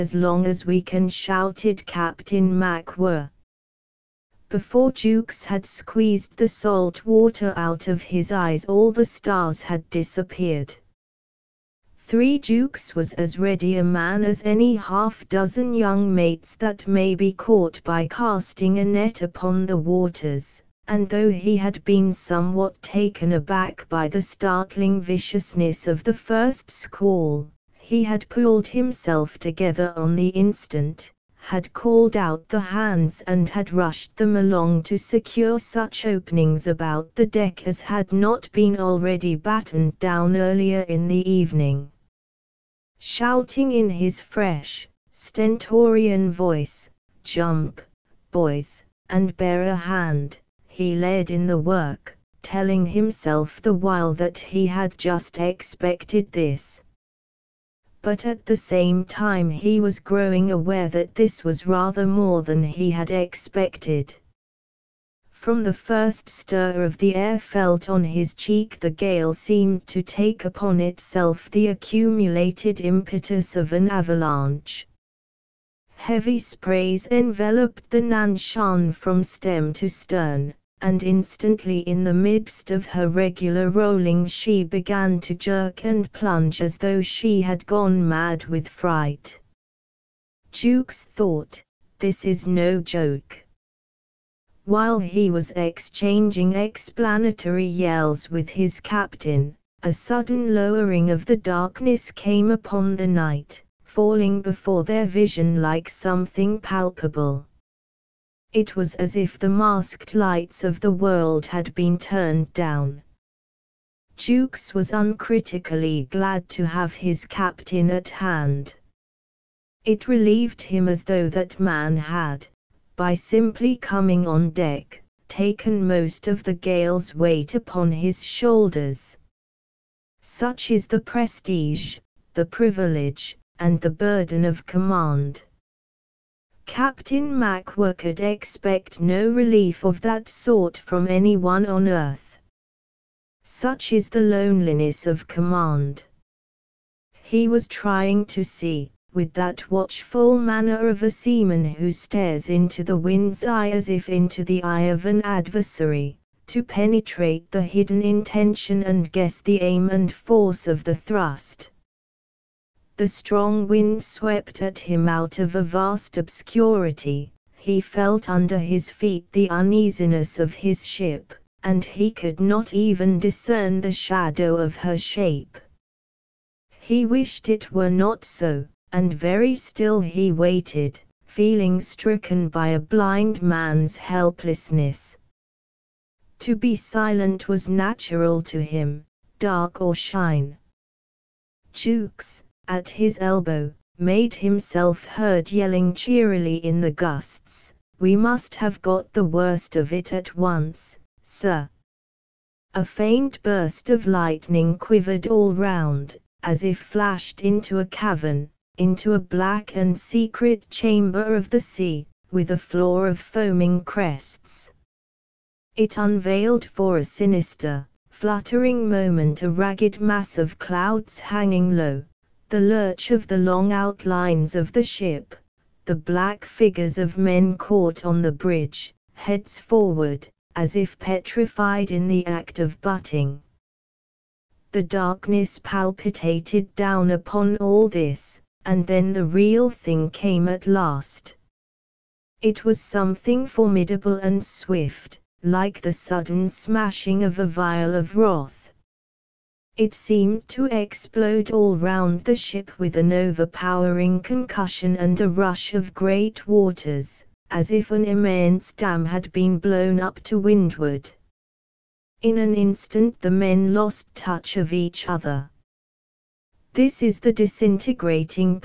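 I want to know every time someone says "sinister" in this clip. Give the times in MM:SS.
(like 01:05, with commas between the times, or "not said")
03:37.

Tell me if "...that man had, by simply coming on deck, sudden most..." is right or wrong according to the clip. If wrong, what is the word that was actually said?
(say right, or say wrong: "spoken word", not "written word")
wrong: "taken", not "sudden".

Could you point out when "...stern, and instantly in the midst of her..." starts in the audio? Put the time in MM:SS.
01:19.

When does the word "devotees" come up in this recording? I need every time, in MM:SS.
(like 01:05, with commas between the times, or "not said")
not said.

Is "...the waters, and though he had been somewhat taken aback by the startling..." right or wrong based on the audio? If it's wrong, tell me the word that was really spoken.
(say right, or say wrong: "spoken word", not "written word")
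right.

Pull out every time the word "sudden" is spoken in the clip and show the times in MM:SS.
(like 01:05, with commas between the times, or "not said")
01:39, 04:05.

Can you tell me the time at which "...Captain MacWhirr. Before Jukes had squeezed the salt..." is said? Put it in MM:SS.
00:01.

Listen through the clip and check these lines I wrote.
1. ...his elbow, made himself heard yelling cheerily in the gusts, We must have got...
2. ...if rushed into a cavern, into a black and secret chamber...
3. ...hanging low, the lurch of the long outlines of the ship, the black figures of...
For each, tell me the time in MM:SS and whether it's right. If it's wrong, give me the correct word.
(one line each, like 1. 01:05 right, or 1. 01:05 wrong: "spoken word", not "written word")
1. 03:12 right
2. 03:26 wrong: "flashed", not "rushed"
3. 03:41 right.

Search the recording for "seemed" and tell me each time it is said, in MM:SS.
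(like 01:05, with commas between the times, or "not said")
01:09, 04:09.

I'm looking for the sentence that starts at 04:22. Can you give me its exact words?
In an instant the men lost touch of each other.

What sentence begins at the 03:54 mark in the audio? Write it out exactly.
The darkness palpitated down upon all this, and then the real thing came at last.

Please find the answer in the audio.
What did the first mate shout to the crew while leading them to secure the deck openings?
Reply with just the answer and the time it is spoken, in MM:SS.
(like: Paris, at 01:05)
Jump, boys, and bear a hand, at 00:47.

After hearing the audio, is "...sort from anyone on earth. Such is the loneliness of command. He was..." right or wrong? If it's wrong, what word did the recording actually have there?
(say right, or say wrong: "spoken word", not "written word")
right.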